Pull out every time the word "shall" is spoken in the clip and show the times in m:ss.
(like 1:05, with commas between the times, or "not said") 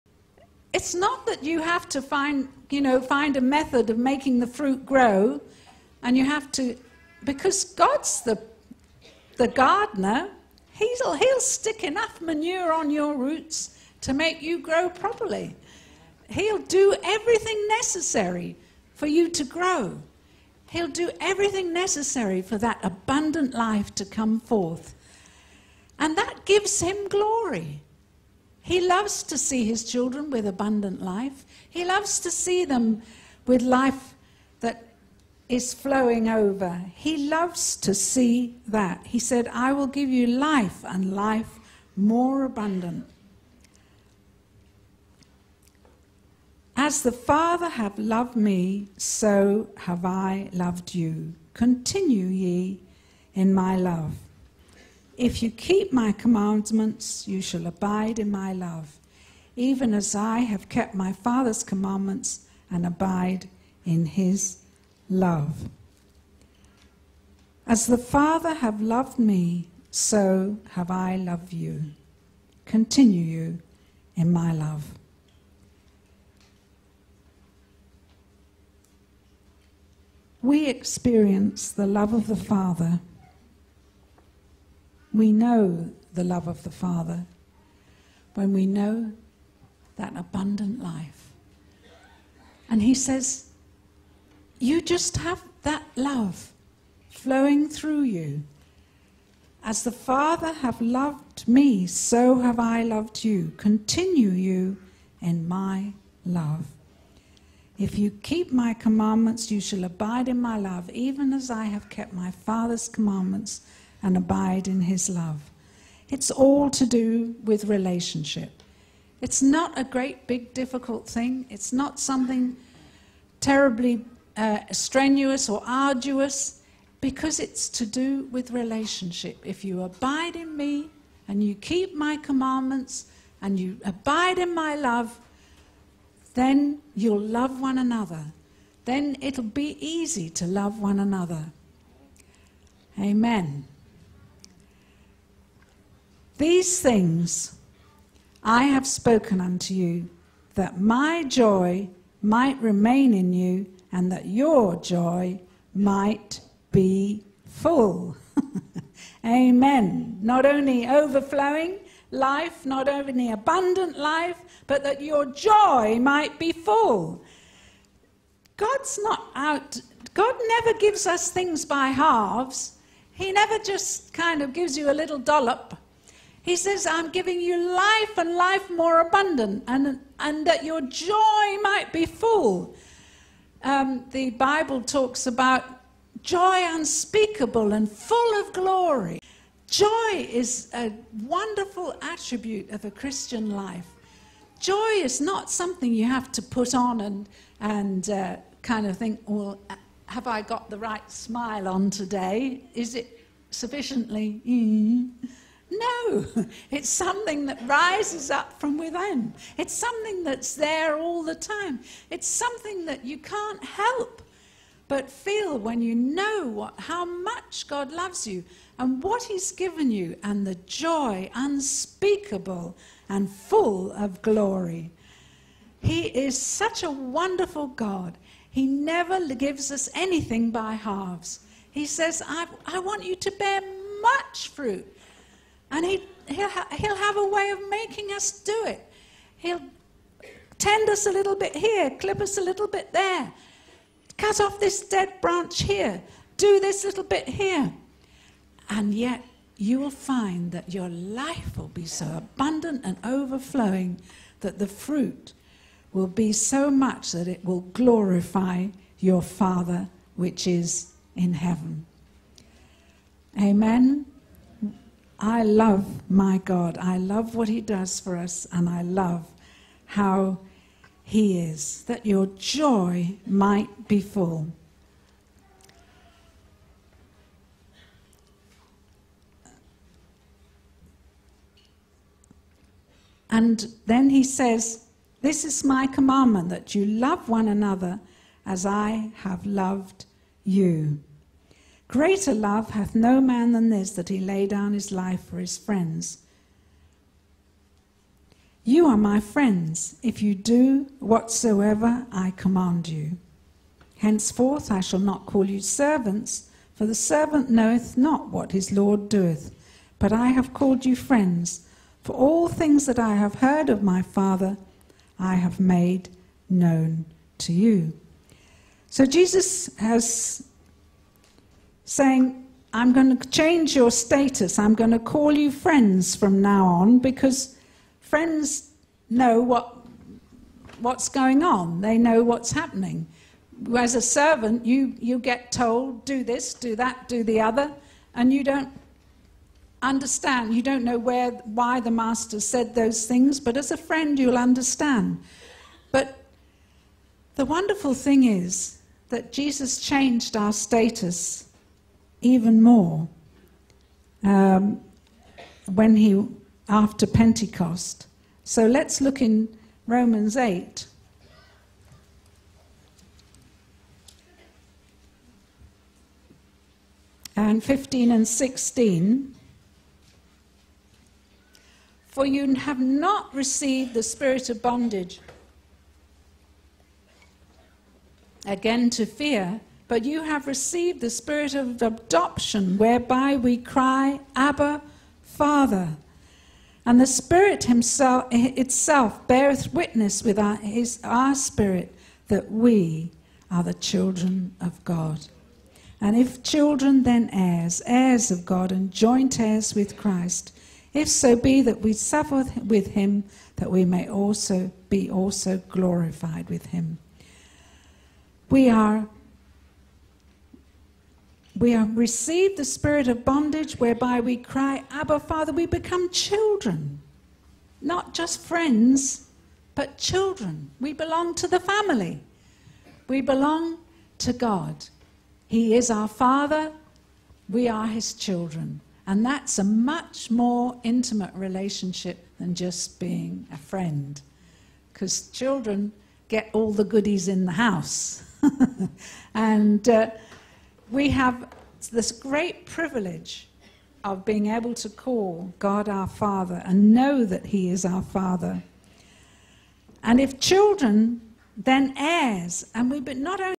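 0:57, 1:49, 5:04.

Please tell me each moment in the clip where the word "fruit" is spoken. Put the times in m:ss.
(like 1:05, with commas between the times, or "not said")
0:04, 3:54, 4:14.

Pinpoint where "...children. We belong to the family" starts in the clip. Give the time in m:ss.
6:59.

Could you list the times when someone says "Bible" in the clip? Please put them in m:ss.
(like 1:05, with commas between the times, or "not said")
3:04.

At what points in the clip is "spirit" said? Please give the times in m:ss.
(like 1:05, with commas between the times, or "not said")
6:14, 6:21, 6:27, 6:31, 6:52.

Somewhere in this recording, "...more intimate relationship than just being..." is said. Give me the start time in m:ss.
7:10.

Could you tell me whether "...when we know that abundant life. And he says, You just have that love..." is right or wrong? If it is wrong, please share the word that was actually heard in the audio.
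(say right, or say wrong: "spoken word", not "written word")
right.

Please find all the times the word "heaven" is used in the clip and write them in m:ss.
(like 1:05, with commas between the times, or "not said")
4:21.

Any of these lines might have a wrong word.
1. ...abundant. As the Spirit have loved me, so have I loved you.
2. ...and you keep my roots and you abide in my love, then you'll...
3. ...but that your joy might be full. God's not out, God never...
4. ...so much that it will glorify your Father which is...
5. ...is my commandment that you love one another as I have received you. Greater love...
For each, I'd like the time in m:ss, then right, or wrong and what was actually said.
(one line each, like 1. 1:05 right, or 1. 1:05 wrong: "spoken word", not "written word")
1. 0:42 wrong: "Father", not "Spirit"
2. 2:11 wrong: "commandments", not "roots"
3. 2:44 right
4. 4:16 right
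5. 4:45 wrong: "loved", not "received".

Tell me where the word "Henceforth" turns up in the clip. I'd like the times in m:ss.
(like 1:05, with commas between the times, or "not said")
5:03.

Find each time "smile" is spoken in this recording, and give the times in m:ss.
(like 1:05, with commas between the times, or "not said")
3:21.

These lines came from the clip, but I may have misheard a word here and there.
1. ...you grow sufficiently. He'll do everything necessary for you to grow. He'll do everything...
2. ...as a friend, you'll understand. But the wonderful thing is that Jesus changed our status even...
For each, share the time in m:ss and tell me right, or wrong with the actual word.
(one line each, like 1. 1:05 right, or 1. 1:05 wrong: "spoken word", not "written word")
1. 0:14 wrong: "properly", not "sufficiently"
2. 5:43 right.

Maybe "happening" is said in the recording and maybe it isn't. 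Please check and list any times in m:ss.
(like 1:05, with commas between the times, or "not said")
5:32.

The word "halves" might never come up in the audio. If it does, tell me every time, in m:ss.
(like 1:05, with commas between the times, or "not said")
2:51, 3:50.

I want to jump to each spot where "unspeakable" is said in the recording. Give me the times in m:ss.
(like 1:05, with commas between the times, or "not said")
3:06, 3:41.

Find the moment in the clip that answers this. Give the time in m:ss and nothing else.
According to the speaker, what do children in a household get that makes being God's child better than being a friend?
7:16.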